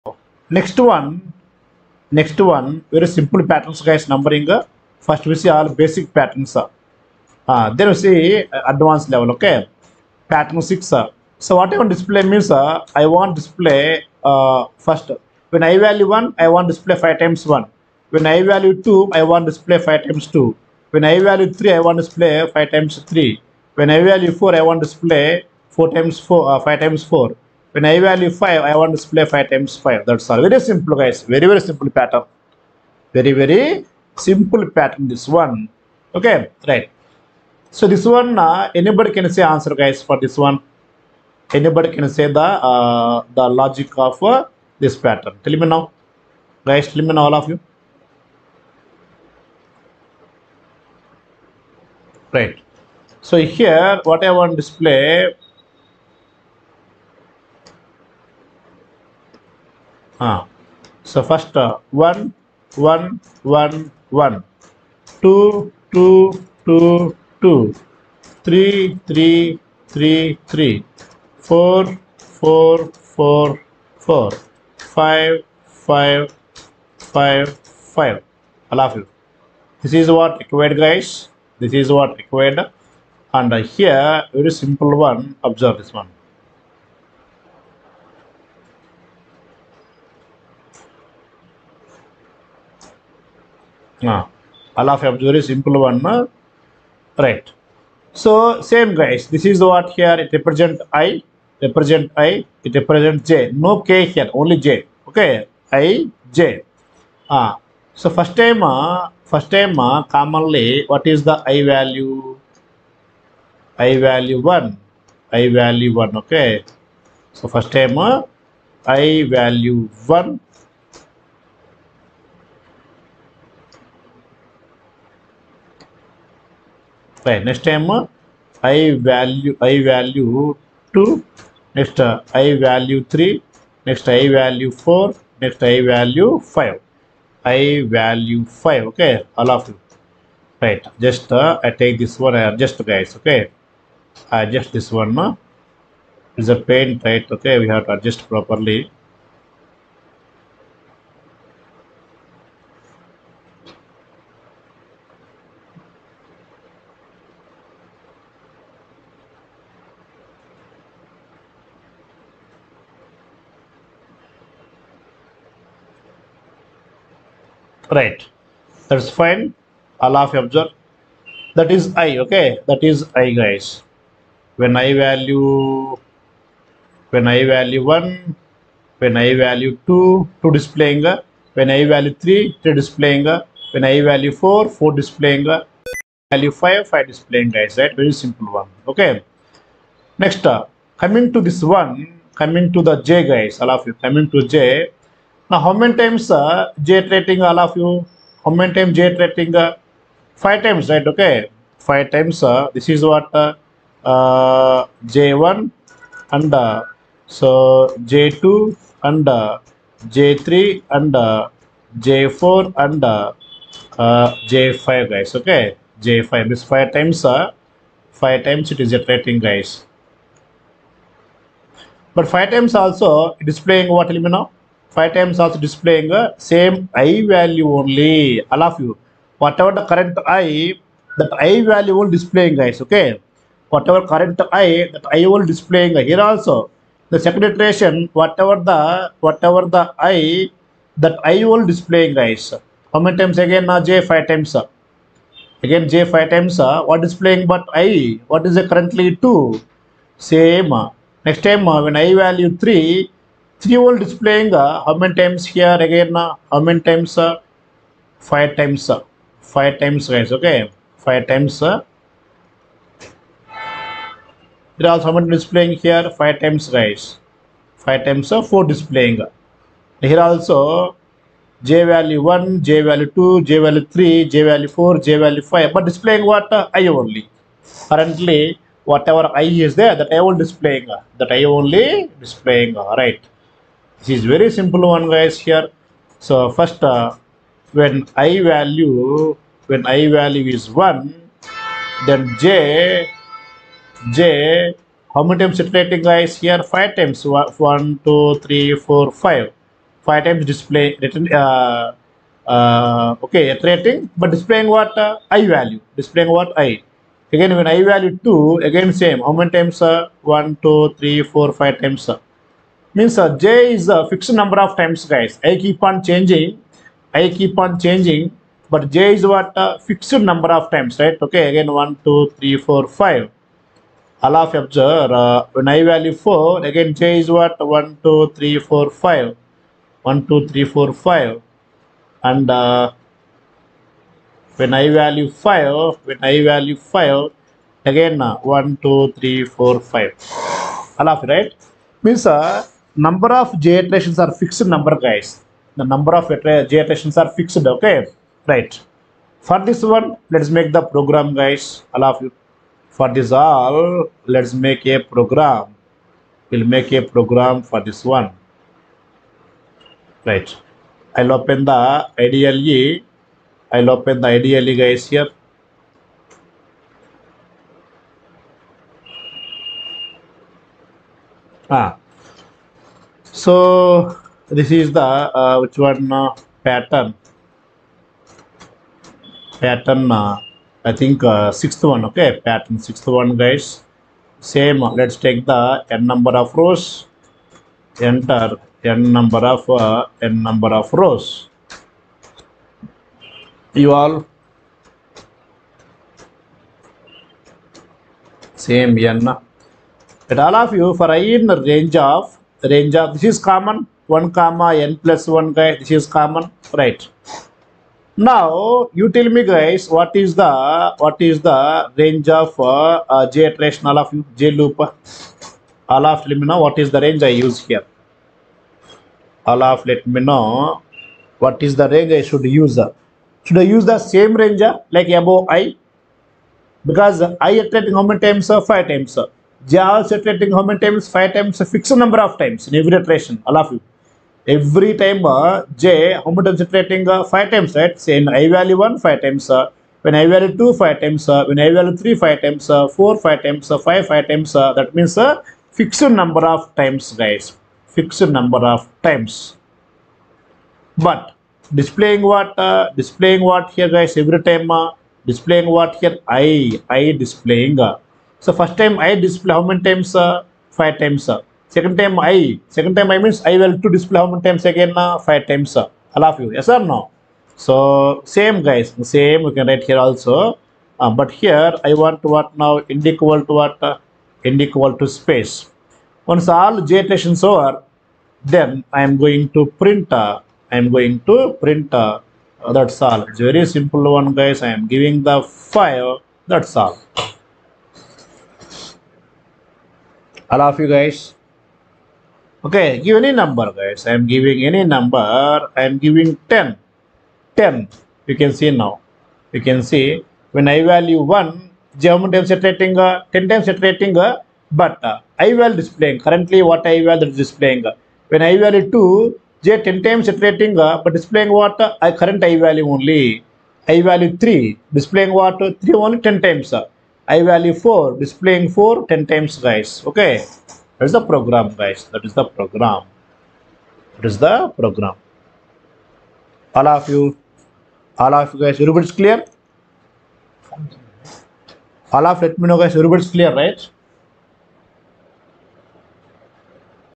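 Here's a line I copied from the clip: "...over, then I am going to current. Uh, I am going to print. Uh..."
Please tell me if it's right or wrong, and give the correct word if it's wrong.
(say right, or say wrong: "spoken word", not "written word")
wrong: "print", not "current".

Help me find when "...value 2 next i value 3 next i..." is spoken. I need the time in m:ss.
2:09.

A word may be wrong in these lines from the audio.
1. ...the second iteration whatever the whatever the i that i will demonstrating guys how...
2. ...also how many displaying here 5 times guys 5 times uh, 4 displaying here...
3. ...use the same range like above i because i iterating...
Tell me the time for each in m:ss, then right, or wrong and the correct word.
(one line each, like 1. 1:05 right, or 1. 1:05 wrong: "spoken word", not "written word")
1. 3:57 wrong: "displaying", not "demonstrating"
2. 4:24 right
3. 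7:03 right.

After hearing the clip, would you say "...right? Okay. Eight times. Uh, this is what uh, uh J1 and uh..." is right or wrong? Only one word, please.
wrong.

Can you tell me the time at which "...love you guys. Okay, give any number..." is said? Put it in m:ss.
8:10.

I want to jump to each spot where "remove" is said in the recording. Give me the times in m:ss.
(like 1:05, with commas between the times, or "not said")
not said.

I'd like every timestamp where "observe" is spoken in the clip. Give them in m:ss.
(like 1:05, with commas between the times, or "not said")
1:25, 5:24.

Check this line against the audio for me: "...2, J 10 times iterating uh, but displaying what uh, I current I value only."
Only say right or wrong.
right.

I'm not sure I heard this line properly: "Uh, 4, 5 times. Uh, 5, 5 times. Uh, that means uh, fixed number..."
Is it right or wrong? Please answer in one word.
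right.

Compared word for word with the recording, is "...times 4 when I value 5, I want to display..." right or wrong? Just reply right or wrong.
right.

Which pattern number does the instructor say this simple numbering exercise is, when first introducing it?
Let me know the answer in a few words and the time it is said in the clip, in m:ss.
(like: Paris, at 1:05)
Pattern 6, at 0:10.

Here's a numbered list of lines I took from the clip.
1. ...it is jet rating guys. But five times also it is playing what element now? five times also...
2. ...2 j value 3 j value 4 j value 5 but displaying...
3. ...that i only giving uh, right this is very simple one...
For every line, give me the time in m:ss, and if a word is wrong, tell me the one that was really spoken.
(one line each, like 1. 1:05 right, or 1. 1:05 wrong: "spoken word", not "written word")
1. 3:38 right
2. 4:33 right
3. 4:41 wrong: "displaying", not "giving".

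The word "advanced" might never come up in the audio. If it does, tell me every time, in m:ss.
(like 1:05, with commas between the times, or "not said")
0:08.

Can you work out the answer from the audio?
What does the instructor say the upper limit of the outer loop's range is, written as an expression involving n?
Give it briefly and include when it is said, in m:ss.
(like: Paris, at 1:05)
n plus 1, at 6:44.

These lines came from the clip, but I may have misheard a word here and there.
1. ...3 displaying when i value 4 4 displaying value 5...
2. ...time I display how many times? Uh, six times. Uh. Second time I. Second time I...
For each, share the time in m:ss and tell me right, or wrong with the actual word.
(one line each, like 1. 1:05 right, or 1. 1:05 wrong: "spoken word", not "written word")
1. 3:02 right
2. 7:38 wrong: "five", not "six".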